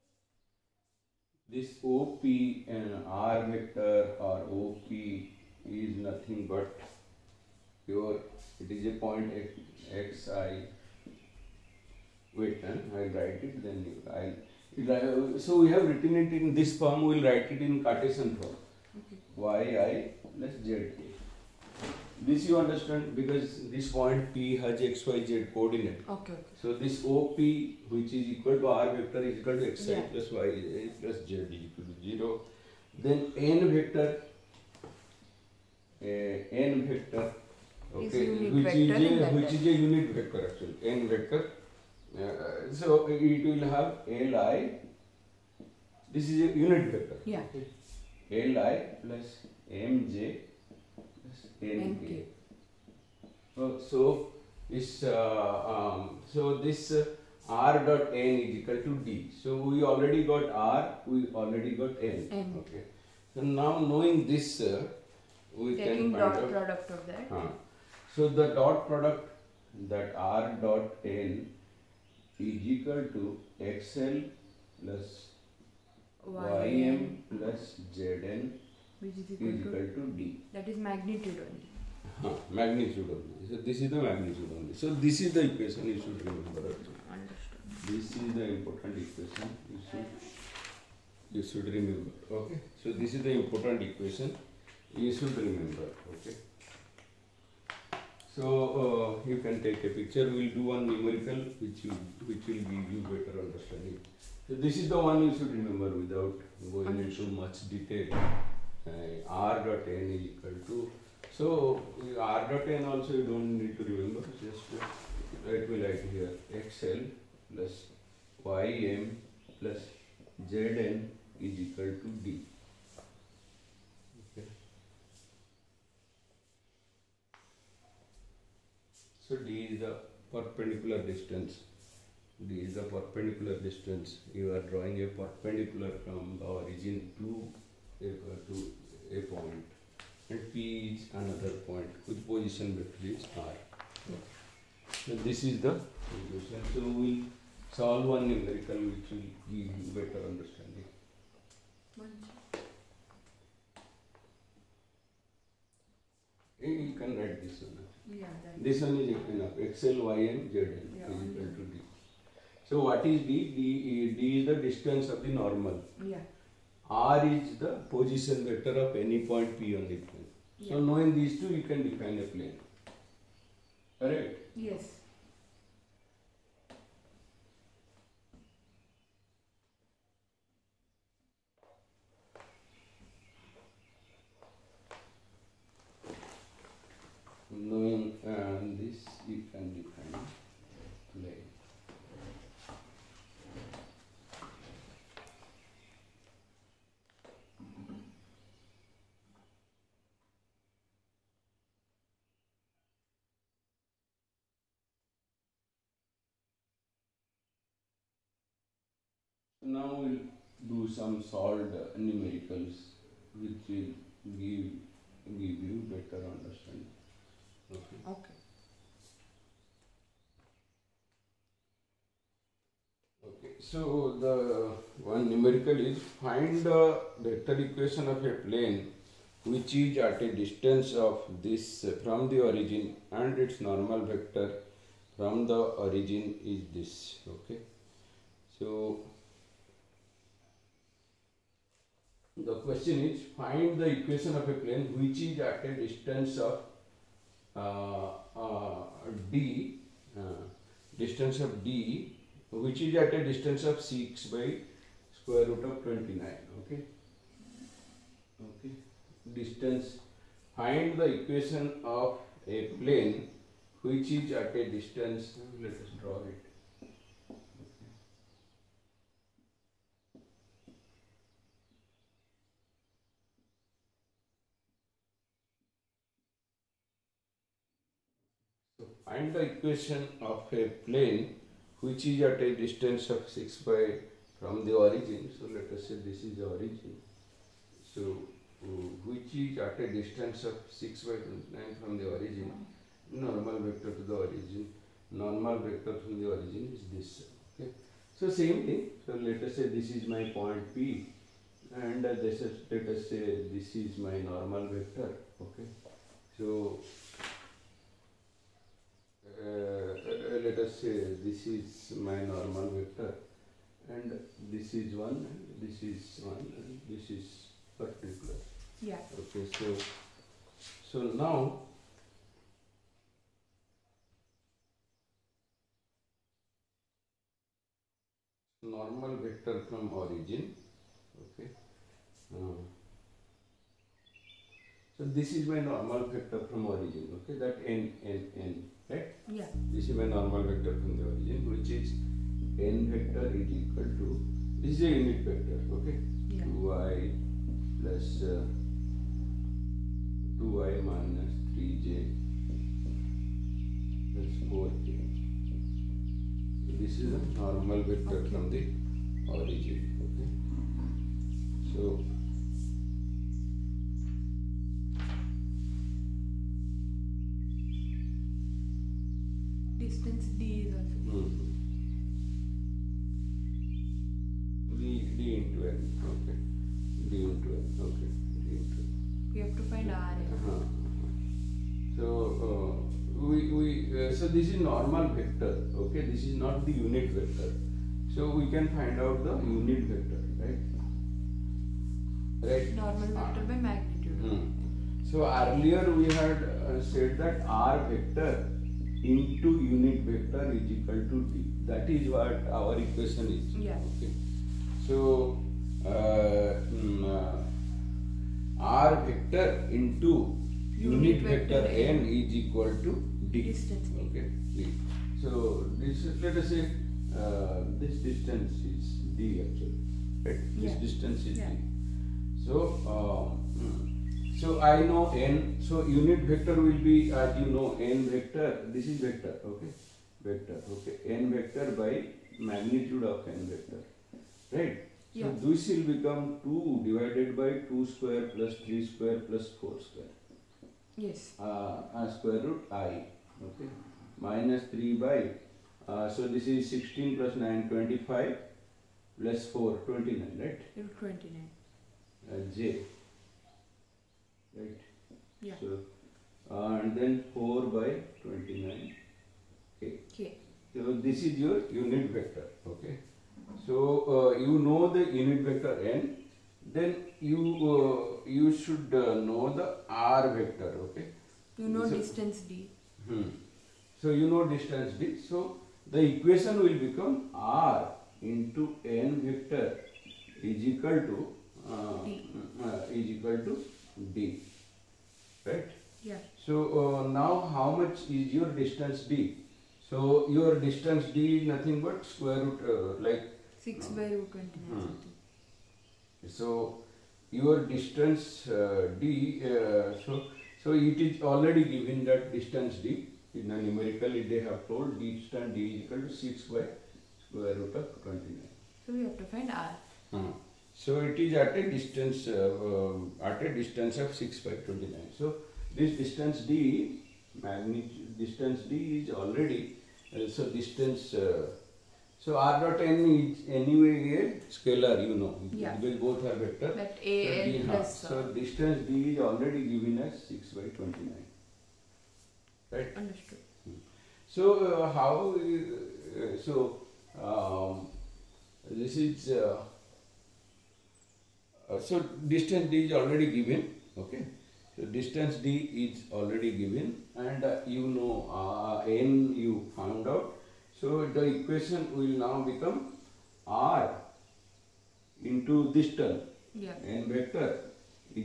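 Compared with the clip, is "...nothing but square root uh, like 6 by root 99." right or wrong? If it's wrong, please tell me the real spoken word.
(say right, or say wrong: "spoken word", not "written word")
wrong: "29", not "99".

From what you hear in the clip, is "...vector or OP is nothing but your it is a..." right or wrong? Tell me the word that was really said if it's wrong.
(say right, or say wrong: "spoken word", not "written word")
right.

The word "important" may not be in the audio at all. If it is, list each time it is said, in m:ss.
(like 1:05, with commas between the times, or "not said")
1:28, 1:33.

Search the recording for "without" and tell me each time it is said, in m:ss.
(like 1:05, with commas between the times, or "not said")
1:45.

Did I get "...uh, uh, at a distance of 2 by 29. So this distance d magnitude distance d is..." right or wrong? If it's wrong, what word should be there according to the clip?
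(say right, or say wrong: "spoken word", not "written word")
wrong: "6", not "2".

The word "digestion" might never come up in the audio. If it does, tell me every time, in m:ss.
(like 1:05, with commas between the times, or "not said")
not said.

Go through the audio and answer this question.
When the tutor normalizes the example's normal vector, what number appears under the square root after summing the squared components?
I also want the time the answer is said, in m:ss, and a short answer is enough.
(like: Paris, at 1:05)
29, at 7:27.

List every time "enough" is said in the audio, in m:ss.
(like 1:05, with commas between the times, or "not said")
2:39.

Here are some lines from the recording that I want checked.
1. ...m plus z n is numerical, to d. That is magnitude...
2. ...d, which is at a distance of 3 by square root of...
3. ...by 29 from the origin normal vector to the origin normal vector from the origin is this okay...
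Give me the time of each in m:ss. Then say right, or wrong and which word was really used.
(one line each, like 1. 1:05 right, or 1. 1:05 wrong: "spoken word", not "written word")
1. 1:16 wrong: "equal", not "numerical"
2. 4:11 wrong: "6", not "3"
3. 4:51 right.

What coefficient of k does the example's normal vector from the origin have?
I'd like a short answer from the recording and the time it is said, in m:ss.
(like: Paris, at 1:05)
4, at 5:54.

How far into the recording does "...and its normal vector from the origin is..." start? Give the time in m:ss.
3:53.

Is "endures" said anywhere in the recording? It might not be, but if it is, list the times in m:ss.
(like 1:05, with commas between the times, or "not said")
not said.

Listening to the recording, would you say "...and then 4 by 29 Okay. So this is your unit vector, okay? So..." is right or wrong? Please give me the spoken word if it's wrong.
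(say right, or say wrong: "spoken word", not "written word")
right.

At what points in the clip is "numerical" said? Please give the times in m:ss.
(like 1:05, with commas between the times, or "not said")
1:40, 2:28, 3:32, 3:45, 8:23.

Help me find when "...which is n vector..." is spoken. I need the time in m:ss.
5:41.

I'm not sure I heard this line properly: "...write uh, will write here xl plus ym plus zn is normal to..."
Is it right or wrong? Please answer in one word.
wrong.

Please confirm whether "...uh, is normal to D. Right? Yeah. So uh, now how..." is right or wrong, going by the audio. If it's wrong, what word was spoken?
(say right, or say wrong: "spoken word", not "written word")
wrong: "equal", not "normal".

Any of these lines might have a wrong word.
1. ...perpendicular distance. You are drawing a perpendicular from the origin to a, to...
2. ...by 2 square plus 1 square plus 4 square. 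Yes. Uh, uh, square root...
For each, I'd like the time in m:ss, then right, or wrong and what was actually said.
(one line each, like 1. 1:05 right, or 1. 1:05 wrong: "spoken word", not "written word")
1. 2:12 right
2. 7:17 wrong: "3", not "1".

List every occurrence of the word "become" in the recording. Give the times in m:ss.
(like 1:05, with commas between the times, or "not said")
7:15, 7:56, 9:12.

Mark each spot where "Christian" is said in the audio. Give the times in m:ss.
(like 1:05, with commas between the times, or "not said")
not said.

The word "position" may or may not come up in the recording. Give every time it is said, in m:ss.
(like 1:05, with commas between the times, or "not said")
2:22, 2:47.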